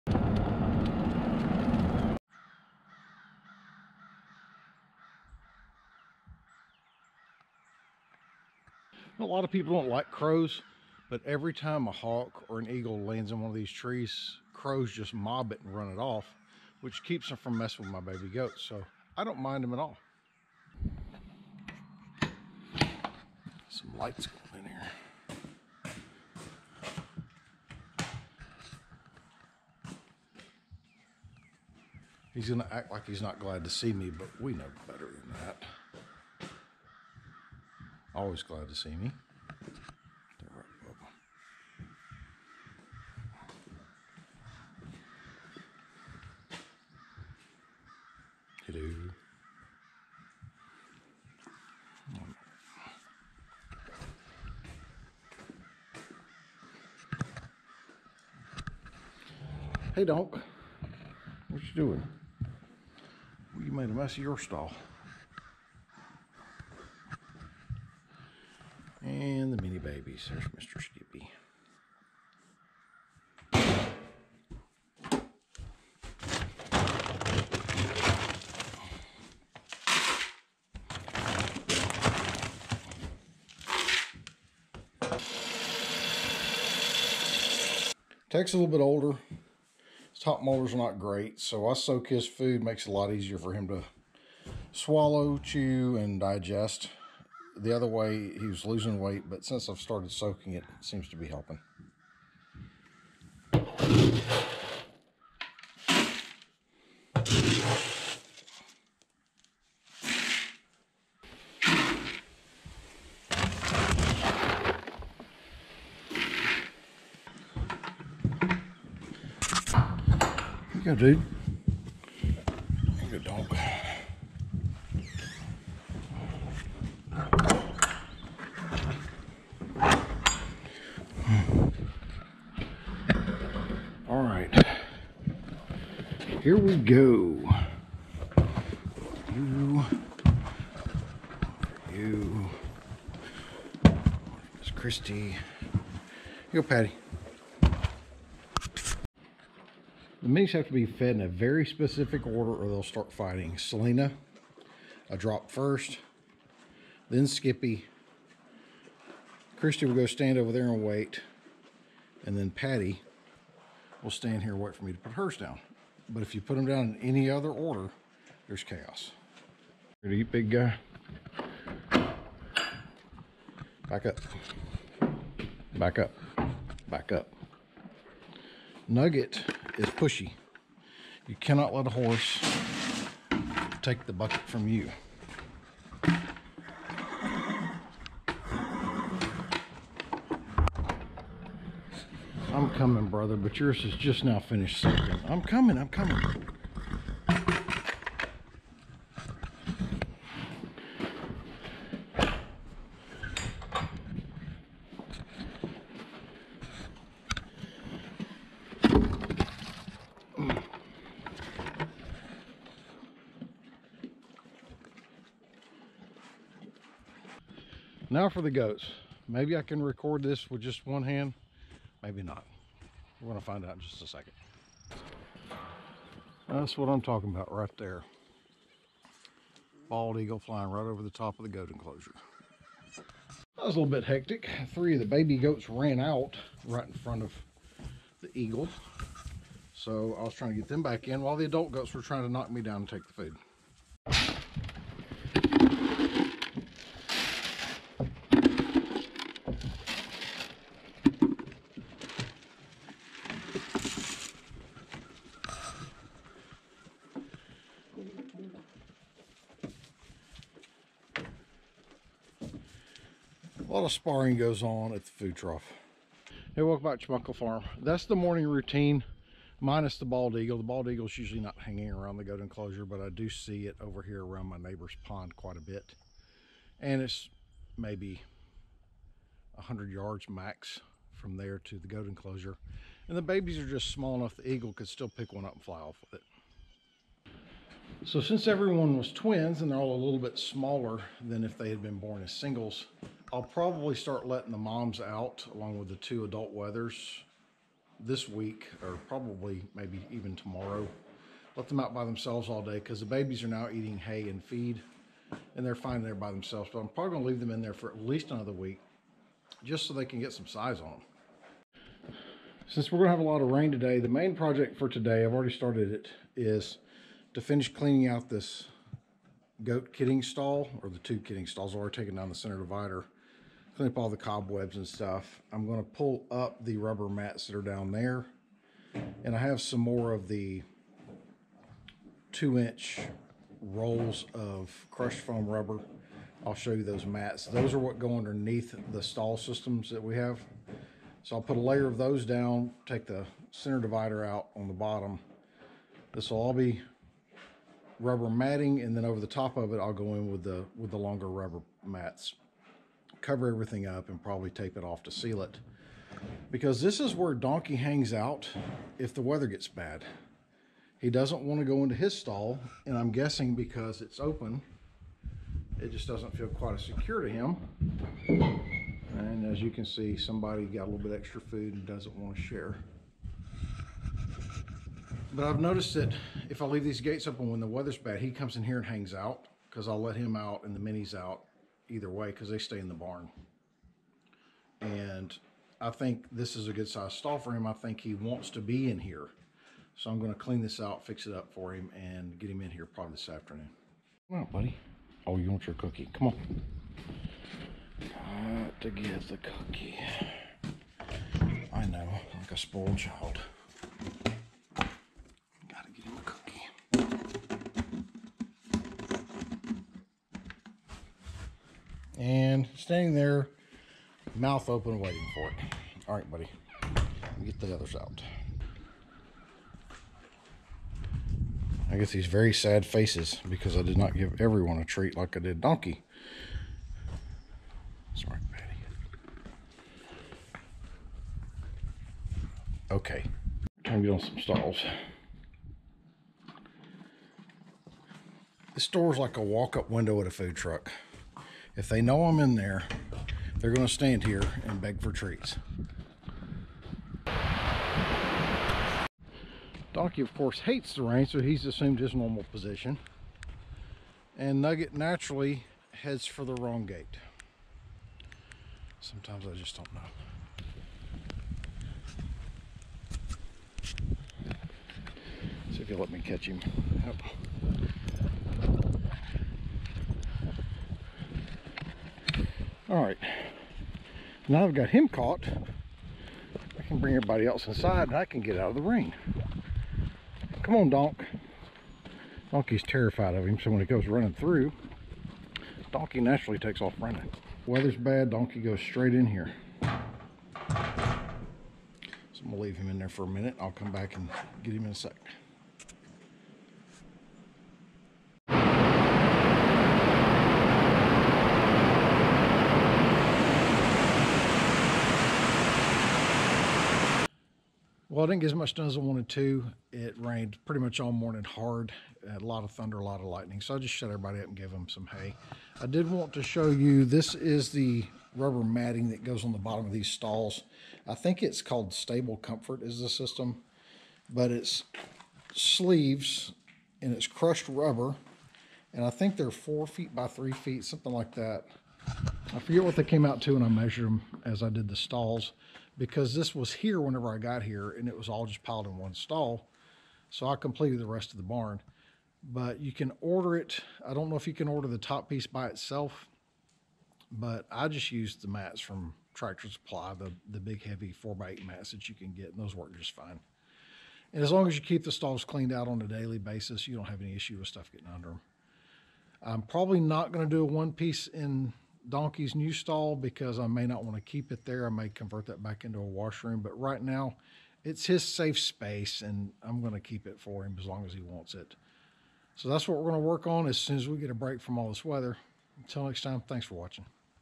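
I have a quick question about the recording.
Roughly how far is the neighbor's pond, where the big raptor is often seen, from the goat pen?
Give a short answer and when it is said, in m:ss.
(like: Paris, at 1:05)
100 yards, at 4:39.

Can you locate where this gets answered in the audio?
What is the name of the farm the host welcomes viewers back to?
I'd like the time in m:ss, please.
4:27.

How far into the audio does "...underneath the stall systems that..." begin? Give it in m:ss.
5:38.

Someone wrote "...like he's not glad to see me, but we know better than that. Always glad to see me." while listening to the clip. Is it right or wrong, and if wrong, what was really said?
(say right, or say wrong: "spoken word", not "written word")
right.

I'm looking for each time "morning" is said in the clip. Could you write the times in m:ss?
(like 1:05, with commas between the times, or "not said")
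4:28, 8:31.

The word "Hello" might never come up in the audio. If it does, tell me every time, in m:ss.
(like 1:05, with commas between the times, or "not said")
0:48.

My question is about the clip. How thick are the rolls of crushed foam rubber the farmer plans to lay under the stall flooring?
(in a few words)
2 inch.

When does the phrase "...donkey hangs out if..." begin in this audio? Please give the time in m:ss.
5:57.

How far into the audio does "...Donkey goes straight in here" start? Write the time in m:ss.
8:08.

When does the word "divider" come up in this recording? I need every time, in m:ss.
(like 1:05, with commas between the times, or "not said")
5:22, 5:43.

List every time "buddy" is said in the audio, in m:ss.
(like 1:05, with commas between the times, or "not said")
6:34, 6:56.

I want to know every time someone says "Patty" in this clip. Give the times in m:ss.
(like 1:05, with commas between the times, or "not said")
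2:26, 2:42, 7:08.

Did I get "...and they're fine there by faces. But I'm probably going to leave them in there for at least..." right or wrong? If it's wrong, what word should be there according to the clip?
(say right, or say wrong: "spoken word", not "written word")
wrong: "themselves", not "faces".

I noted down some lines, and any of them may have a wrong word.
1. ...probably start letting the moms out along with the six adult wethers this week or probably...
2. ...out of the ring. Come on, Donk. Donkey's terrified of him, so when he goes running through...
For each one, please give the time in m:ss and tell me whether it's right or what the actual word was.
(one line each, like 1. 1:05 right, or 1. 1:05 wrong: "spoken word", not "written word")
1. 4:53 wrong: "two", not "six"
2. 7:58 right.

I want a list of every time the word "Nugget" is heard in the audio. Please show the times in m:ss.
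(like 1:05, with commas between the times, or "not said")
2:58, 7:34.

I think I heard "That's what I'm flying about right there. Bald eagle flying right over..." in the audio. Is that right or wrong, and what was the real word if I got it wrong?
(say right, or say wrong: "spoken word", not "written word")
wrong: "talking", not "flying".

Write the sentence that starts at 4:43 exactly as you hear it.
And the babies are just small enough the eagle could still pick one up and fly off with it.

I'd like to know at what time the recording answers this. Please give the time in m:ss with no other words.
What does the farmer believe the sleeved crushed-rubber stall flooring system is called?
8:41.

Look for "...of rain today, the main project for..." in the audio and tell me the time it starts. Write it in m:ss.
5:13.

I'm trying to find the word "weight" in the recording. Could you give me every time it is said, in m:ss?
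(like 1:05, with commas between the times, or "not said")
1:38.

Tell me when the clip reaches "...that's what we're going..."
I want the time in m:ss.
9:32.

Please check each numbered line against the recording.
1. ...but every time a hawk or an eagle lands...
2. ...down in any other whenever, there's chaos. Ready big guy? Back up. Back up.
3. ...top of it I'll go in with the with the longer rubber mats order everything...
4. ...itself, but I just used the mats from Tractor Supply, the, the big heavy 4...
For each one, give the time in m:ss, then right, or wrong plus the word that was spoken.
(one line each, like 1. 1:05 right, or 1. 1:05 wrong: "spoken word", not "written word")
1. 0:11 right
2. 2:46 wrong: "order", not "whenever"
3. 5:49 wrong: "cover", not "order"
4. 9:05 right.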